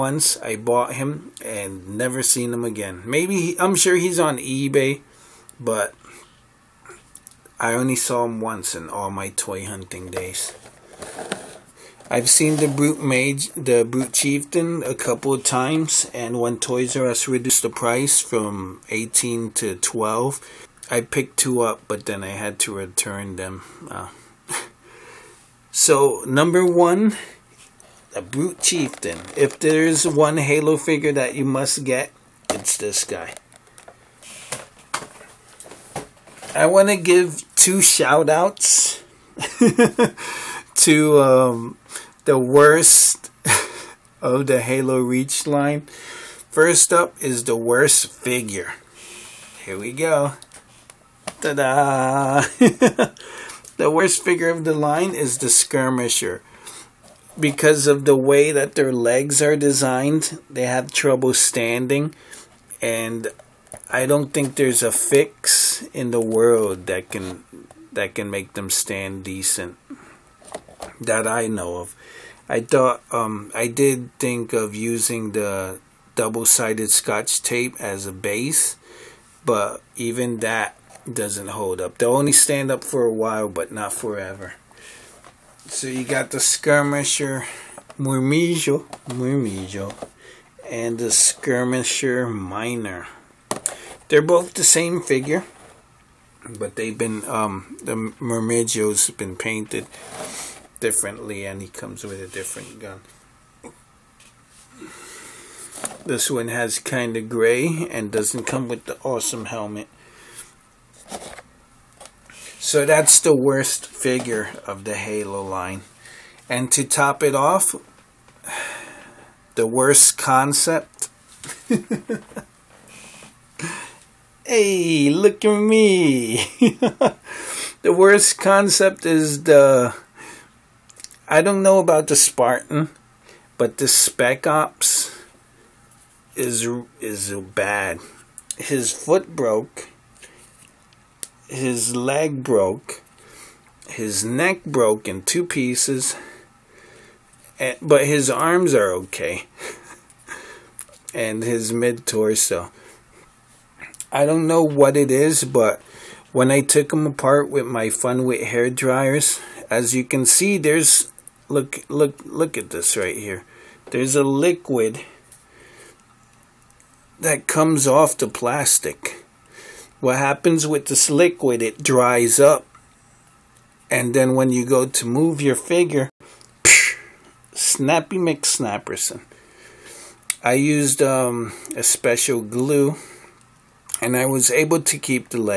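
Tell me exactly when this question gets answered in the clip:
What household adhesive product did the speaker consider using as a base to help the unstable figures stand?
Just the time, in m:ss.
1:16.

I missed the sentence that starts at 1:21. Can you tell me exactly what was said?
They'll only stand up for a while, but not forever.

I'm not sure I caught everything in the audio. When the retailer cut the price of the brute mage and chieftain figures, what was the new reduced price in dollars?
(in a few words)
12.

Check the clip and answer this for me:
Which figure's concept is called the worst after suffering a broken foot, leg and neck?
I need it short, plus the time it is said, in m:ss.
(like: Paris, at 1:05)
Spec Ops, at 2:13.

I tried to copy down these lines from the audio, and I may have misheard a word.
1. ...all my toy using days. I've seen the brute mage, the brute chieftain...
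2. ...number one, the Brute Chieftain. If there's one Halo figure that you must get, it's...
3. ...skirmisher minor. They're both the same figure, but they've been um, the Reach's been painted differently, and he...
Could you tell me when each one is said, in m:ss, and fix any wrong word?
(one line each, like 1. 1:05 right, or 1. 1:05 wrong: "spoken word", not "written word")
1. 0:08 wrong: "hunting", not "using"
2. 0:26 right
3. 1:31 wrong: "Murmijo", not "Reach".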